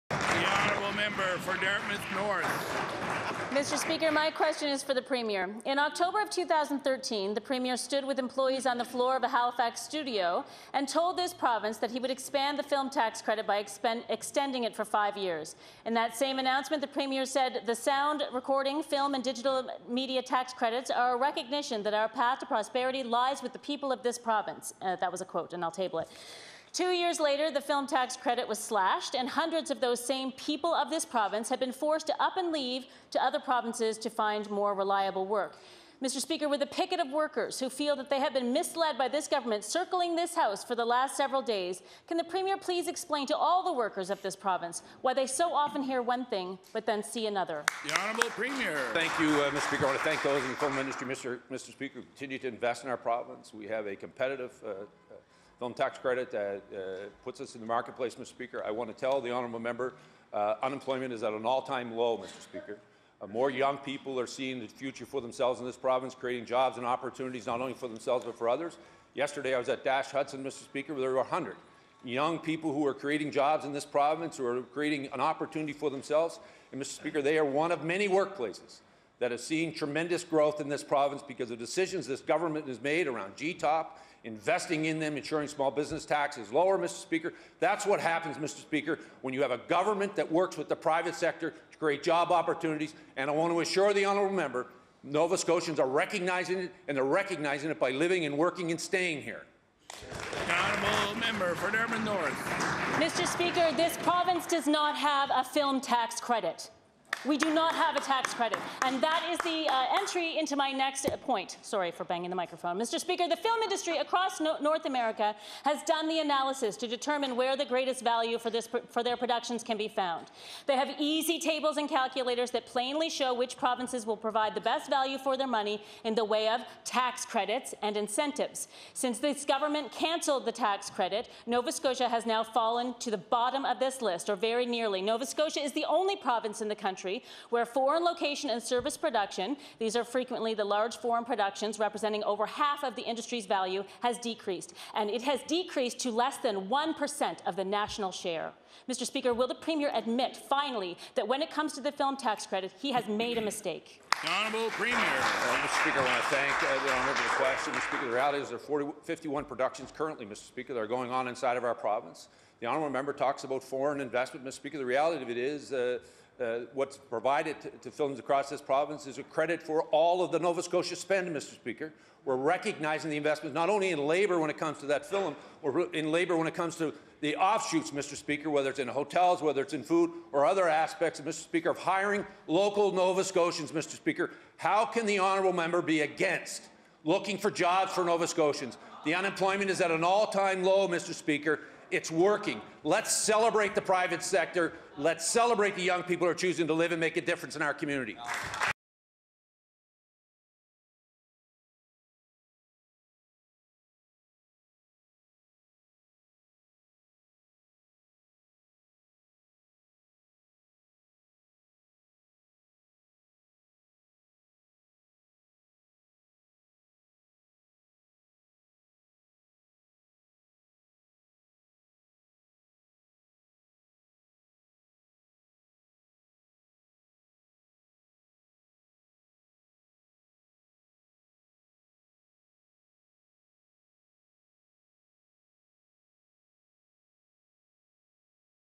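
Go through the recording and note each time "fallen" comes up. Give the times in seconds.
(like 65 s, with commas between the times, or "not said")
132 s.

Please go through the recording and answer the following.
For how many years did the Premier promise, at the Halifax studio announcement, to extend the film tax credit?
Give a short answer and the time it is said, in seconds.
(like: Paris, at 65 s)
5, at 14 s.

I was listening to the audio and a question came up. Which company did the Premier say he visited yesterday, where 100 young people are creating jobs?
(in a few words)
Dash Hudson.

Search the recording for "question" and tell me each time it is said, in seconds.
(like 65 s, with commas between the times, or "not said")
4 s, 157 s.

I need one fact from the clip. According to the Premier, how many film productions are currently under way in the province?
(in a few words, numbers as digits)
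51.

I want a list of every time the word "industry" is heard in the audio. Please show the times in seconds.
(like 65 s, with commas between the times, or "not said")
50 s, 113 s, 143 s.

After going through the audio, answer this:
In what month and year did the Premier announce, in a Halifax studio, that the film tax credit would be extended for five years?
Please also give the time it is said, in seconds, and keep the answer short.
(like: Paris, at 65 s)
October 2013, at 5 s.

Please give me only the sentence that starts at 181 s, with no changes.
Speaker, of hiring local Nova Scotians, Mr.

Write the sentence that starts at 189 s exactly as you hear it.
The unemployment is at an all-time low, Mr.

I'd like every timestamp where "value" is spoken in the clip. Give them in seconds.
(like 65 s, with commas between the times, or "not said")
118 s, 124 s, 143 s.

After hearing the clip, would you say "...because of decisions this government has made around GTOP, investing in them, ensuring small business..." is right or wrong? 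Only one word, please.
right.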